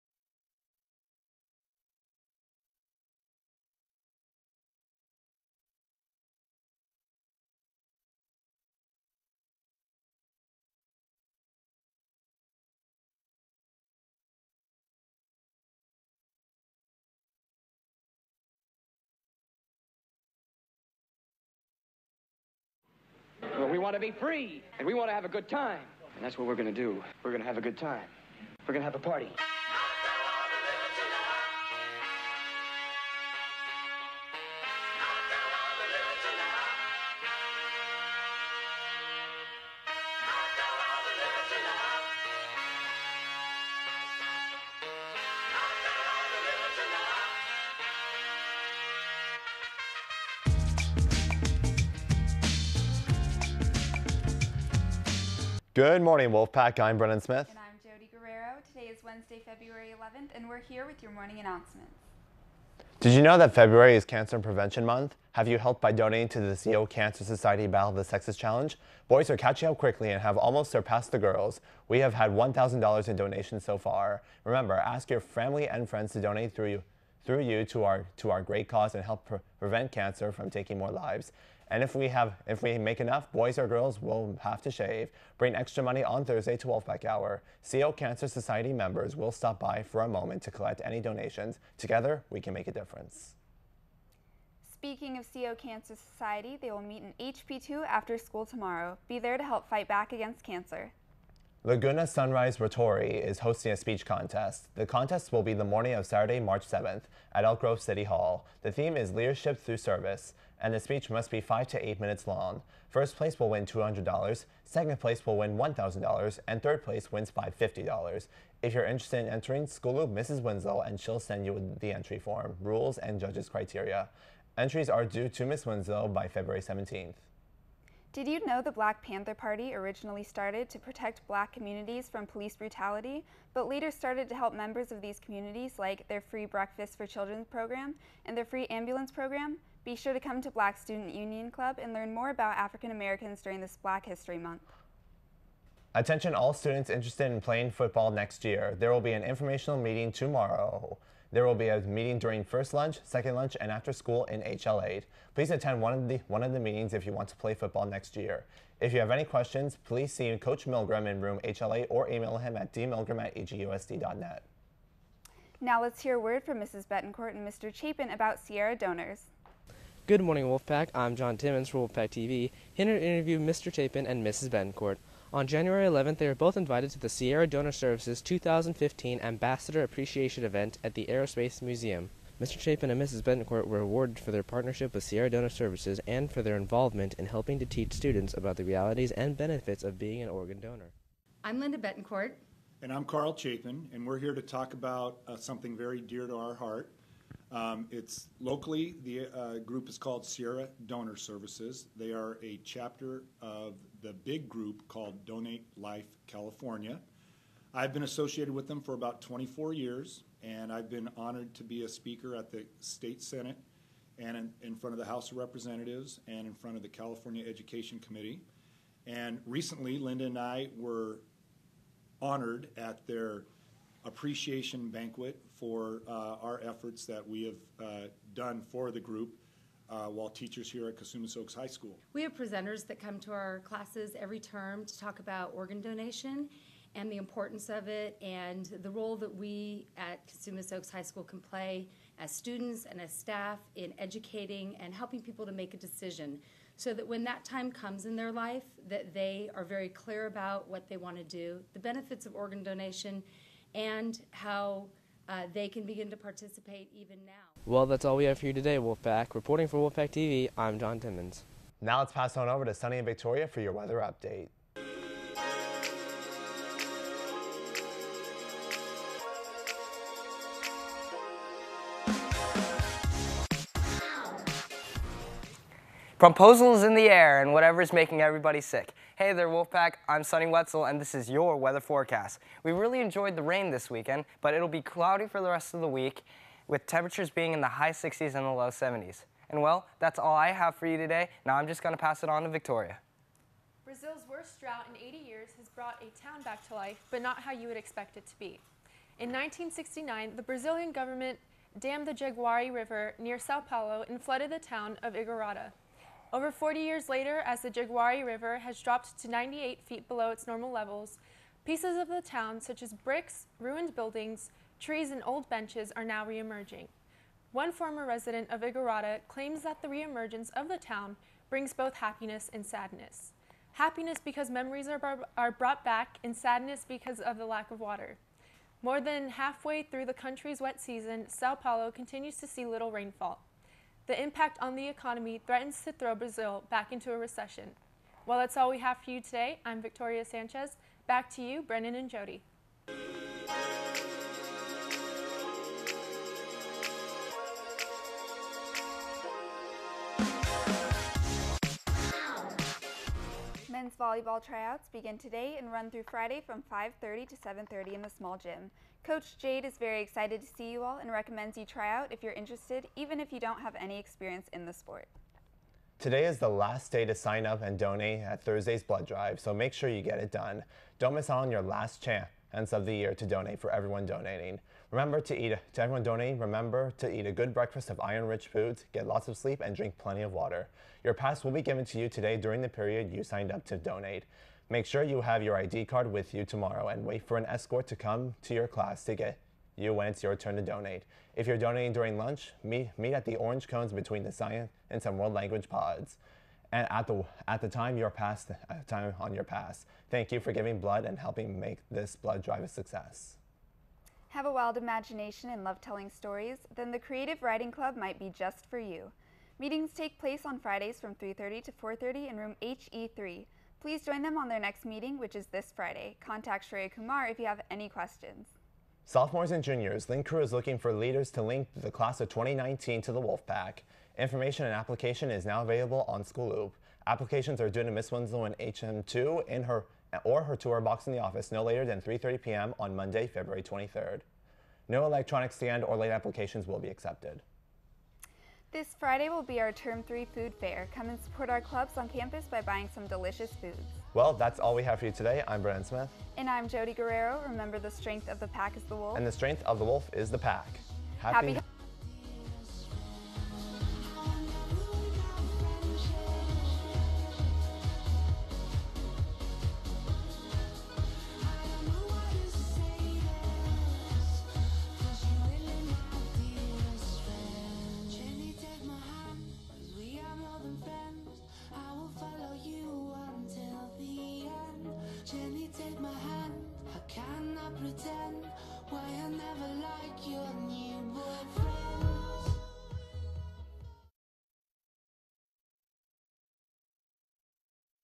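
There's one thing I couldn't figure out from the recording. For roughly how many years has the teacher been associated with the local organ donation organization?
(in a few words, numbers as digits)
24 years.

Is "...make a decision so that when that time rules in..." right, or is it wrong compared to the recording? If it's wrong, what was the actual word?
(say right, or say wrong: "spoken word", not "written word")
wrong: "comes", not "rules".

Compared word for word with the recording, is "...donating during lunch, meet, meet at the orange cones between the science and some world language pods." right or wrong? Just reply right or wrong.
right.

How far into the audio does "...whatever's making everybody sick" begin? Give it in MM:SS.
04:37.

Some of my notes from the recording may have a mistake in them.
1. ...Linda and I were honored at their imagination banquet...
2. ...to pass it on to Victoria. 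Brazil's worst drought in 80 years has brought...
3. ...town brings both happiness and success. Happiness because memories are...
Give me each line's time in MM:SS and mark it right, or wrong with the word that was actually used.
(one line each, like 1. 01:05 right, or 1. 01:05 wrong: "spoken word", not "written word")
1. 03:39 wrong: "appreciation", not "imagination"
2. 04:51 right
3. 05:20 wrong: "sadness", not "success".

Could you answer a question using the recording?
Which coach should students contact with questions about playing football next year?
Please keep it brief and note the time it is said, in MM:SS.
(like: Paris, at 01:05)
Coach Milgram, at 02:40.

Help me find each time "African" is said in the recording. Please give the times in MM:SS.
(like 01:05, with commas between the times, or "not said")
02:22.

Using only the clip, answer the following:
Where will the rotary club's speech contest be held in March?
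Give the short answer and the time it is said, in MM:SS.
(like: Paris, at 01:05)
Elk Grove City Hall, at 01:47.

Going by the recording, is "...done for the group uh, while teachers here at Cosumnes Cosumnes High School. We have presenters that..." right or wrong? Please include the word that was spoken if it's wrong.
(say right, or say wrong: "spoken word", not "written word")
wrong: "Oaks", not "Cosumnes".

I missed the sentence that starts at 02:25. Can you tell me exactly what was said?
Attention all students interested in playing football next year.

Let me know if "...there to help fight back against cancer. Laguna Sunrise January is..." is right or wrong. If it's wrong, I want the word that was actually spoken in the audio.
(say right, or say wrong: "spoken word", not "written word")
wrong: "Rotary", not "January".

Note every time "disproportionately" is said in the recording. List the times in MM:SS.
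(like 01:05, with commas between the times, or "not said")
not said.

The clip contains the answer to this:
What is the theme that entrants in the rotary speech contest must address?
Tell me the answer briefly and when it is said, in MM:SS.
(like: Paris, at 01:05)
Leadership Through Service, at 01:49.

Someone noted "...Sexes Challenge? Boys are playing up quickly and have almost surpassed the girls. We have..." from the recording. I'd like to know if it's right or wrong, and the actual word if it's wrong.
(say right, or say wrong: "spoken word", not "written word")
wrong: "catching", not "playing".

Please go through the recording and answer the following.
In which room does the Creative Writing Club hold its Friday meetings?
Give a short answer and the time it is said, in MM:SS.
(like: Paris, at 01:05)
HE3, at 06:52.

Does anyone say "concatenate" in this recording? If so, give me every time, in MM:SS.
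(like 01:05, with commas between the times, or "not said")
not said.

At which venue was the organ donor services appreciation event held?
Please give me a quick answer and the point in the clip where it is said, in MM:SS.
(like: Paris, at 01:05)
Aerospace Museum, at 03:01.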